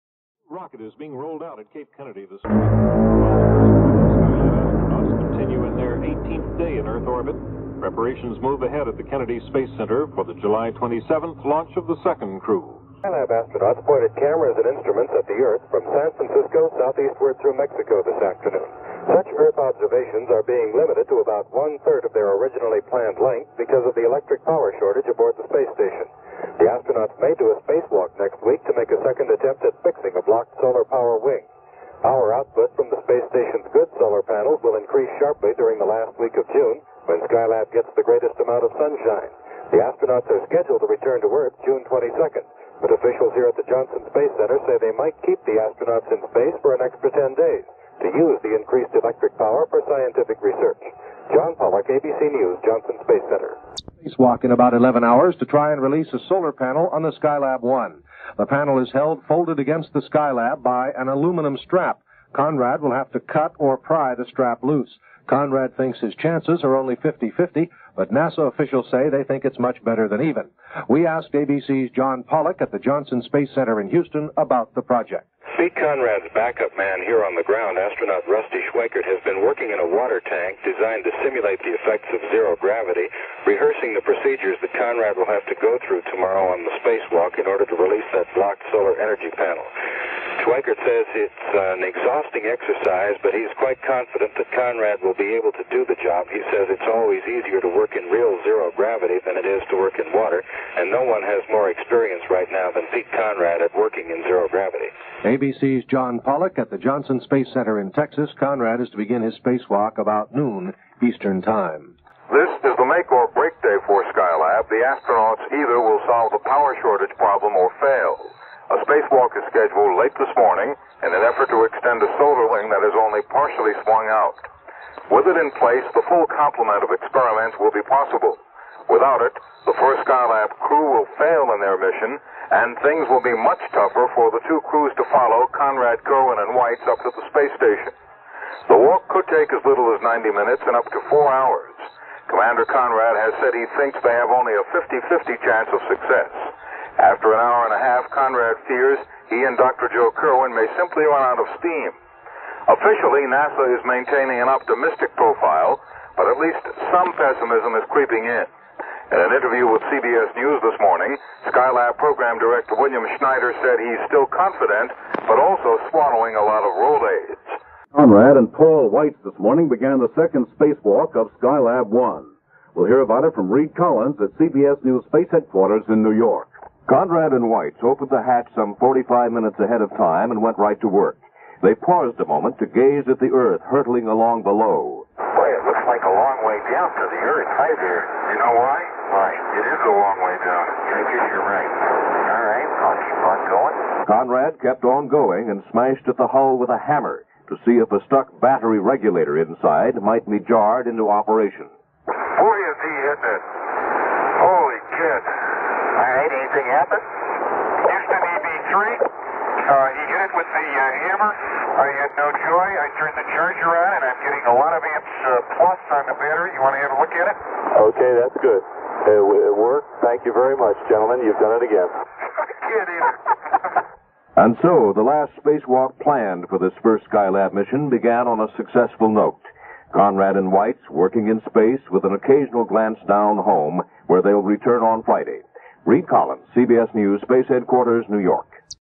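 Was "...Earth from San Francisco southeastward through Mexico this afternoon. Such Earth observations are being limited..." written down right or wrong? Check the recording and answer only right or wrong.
right.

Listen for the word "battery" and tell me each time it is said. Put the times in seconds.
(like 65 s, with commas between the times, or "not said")
198 s, 216 s.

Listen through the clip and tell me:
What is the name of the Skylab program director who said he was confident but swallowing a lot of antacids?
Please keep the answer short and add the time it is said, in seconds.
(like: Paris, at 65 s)
William Schneider, at 162 s.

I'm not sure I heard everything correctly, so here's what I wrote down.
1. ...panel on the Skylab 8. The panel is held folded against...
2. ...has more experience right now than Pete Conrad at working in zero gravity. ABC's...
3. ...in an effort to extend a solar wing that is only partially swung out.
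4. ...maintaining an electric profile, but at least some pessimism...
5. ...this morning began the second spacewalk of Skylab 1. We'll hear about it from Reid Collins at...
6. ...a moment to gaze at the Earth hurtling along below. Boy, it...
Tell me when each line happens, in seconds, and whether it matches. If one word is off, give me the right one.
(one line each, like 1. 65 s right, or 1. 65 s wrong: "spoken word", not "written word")
1. 56 s wrong: "1", not "8"
2. 101 s right
3. 121 s right
4. 153 s wrong: "optimistic", not "electric"
5. 169 s right
6. 182 s right.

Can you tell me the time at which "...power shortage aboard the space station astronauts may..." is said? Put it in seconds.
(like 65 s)
24 s.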